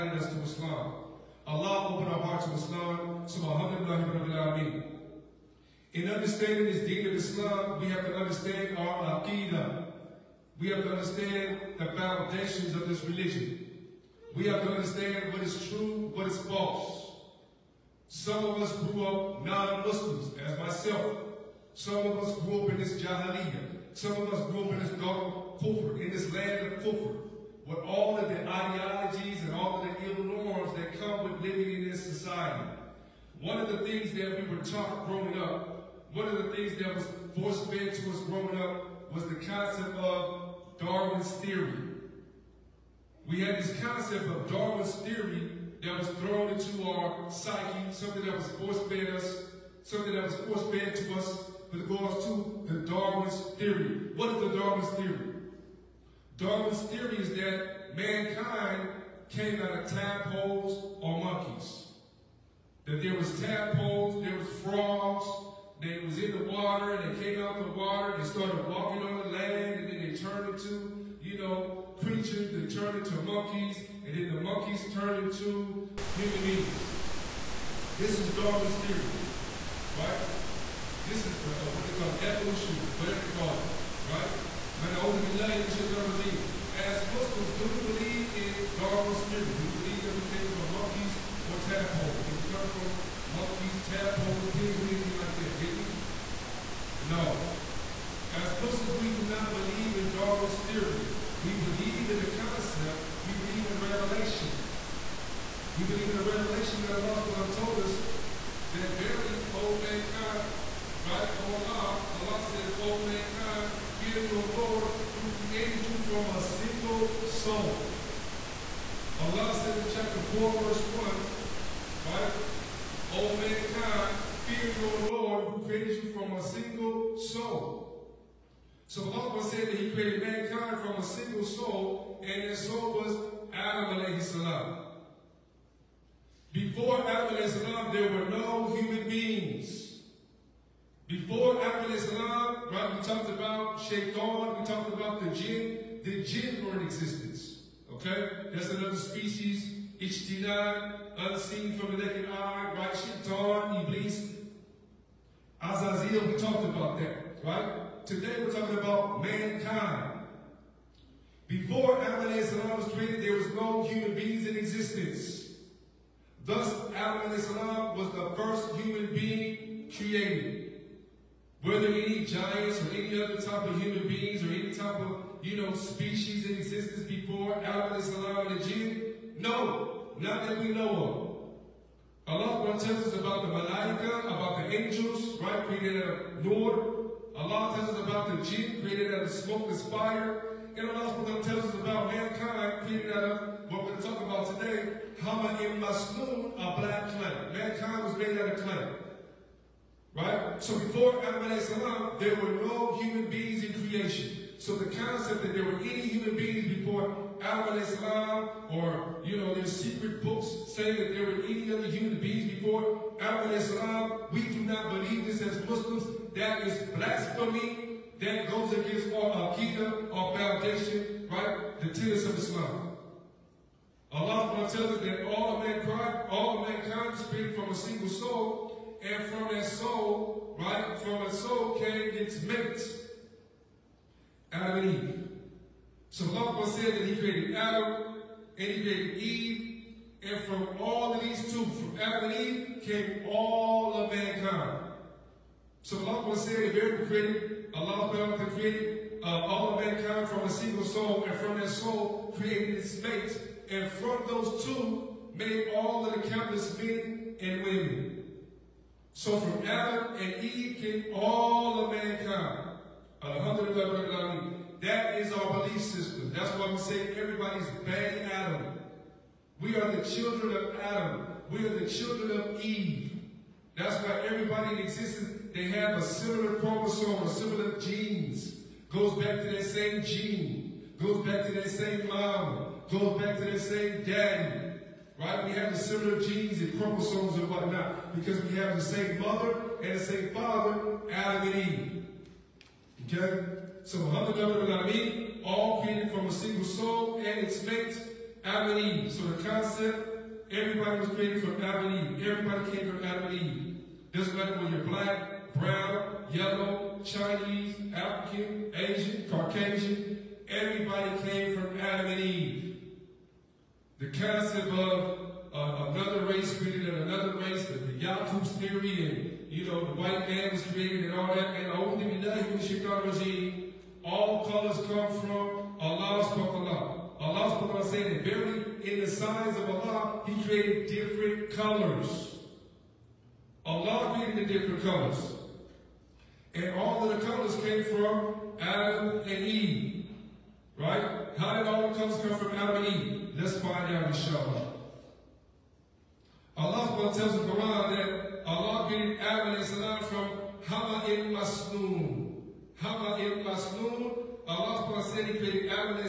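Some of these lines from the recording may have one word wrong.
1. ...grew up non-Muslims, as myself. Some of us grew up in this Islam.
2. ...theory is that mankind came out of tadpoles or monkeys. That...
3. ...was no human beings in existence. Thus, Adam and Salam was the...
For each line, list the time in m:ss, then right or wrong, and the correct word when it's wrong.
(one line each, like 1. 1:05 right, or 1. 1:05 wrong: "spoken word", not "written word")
1. 0:18 wrong: "Jahiliyyah", not "Islam"
2. 0:56 right
3. 2:43 right.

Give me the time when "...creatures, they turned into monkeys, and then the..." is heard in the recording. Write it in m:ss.
1:12.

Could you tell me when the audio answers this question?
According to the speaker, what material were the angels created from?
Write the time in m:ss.
3:06.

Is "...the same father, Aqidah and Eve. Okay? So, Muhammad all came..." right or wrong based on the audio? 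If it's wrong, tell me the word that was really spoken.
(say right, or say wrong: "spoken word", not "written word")
wrong: "Adam", not "Aqidah".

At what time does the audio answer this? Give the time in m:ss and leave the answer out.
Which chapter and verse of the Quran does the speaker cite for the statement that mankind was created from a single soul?
1:59.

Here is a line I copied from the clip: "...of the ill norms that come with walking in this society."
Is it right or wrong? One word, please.
wrong.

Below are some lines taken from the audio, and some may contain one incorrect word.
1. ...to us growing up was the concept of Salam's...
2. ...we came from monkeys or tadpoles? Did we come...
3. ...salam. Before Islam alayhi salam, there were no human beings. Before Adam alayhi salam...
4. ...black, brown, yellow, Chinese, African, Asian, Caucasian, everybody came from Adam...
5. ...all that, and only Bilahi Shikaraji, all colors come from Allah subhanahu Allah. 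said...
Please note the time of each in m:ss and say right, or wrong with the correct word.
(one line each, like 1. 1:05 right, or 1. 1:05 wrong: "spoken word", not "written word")
1. 0:37 wrong: "Darwin", not "Salam"
2. 1:30 right
3. 2:14 wrong: "Adam", not "Islam"
4. 5:04 right
5. 5:21 right.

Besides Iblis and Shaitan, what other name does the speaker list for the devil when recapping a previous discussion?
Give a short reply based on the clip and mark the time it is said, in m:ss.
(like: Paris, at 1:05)
Azazel, at 2:35.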